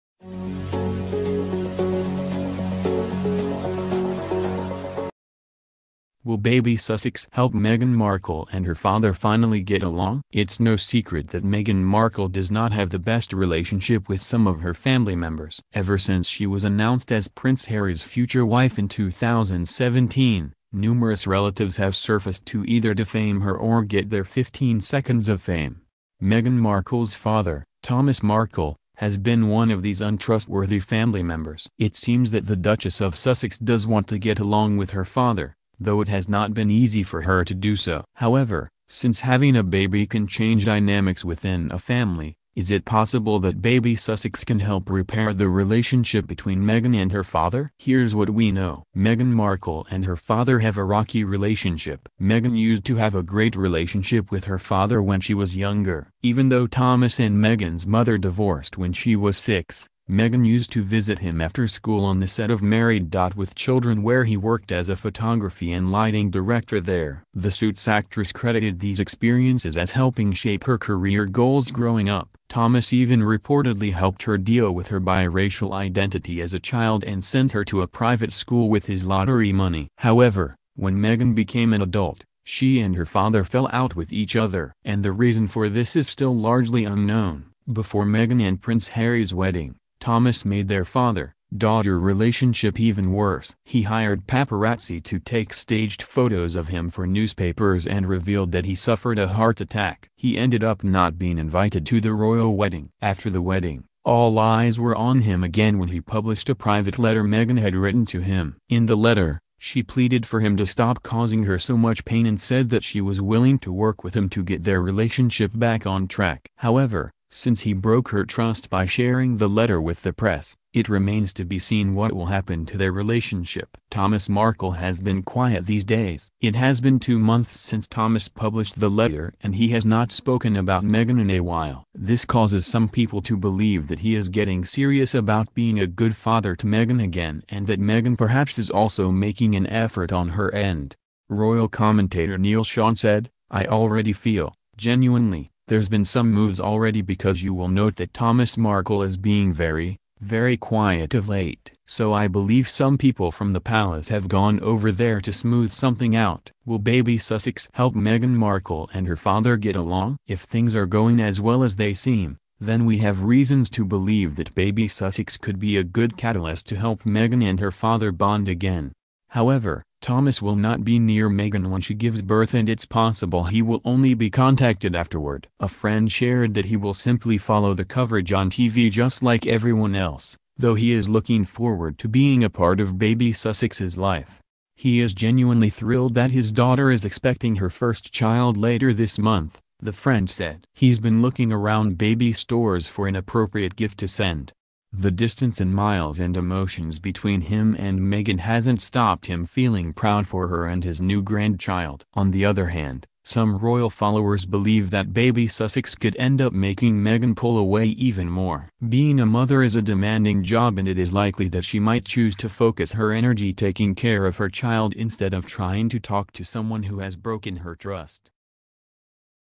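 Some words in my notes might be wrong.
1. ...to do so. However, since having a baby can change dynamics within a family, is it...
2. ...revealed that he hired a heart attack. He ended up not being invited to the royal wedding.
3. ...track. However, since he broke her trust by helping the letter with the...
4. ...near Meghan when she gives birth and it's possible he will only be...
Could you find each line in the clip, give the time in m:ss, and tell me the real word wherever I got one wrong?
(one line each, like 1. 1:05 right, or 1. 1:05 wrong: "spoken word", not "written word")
1. 0:37 right
2. 1:38 wrong: "suffered", not "hired"
3. 1:56 wrong: "sharing", not "helping"
4. 2:50 right.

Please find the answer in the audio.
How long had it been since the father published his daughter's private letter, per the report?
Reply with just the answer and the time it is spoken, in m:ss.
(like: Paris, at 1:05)
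2 months, at 2:06.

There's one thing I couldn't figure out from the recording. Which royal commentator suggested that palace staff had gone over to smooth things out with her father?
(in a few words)
Neil Sean.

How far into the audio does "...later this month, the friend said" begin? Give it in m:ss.
3:08.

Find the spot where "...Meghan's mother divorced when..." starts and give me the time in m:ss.
0:57.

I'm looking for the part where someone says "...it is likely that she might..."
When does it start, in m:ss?
3:30.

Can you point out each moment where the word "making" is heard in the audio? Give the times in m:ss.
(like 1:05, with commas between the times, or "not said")
2:19, 3:26.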